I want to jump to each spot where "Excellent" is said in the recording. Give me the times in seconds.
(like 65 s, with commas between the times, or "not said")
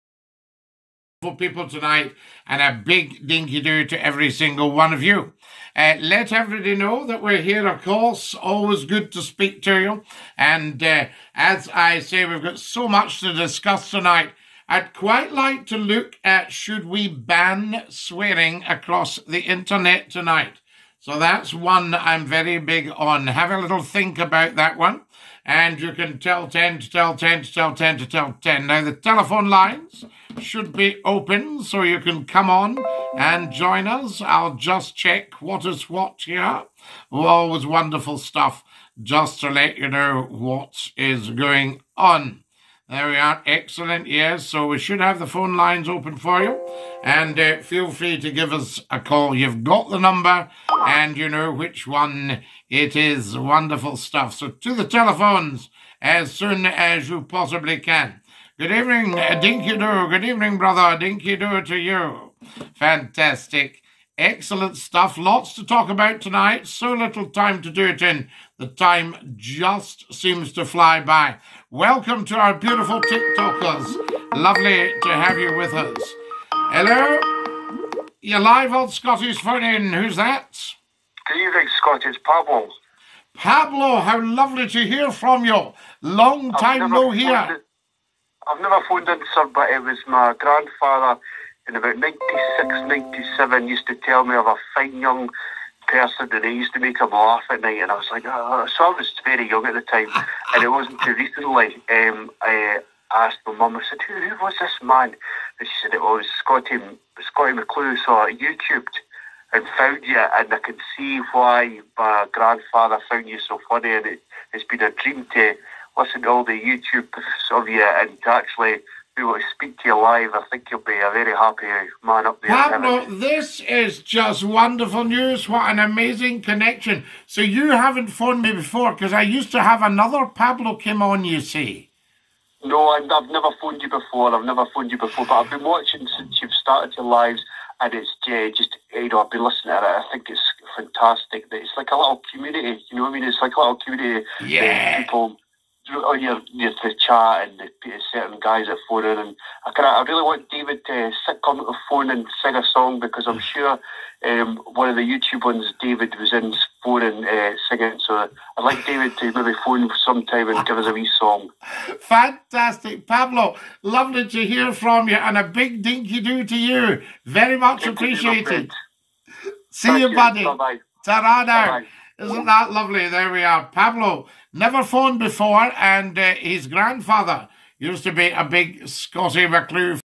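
43 s, 64 s.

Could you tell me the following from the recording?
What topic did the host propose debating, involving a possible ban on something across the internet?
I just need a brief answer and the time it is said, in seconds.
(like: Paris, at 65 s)
Swearing, at 17 s.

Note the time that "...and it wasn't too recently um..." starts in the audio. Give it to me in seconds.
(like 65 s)
100 s.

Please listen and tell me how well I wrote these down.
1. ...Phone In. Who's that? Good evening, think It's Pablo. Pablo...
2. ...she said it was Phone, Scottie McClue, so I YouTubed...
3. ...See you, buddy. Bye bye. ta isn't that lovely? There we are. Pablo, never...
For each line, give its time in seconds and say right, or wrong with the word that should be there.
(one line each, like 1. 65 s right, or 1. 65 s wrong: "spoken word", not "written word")
1. 79 s right
2. 105 s wrong: "Scottie", not "Phone"
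3. 169 s right.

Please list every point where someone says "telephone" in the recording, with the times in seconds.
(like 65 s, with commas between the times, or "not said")
28 s, 54 s.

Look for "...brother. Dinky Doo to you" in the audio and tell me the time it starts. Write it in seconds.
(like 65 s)
60 s.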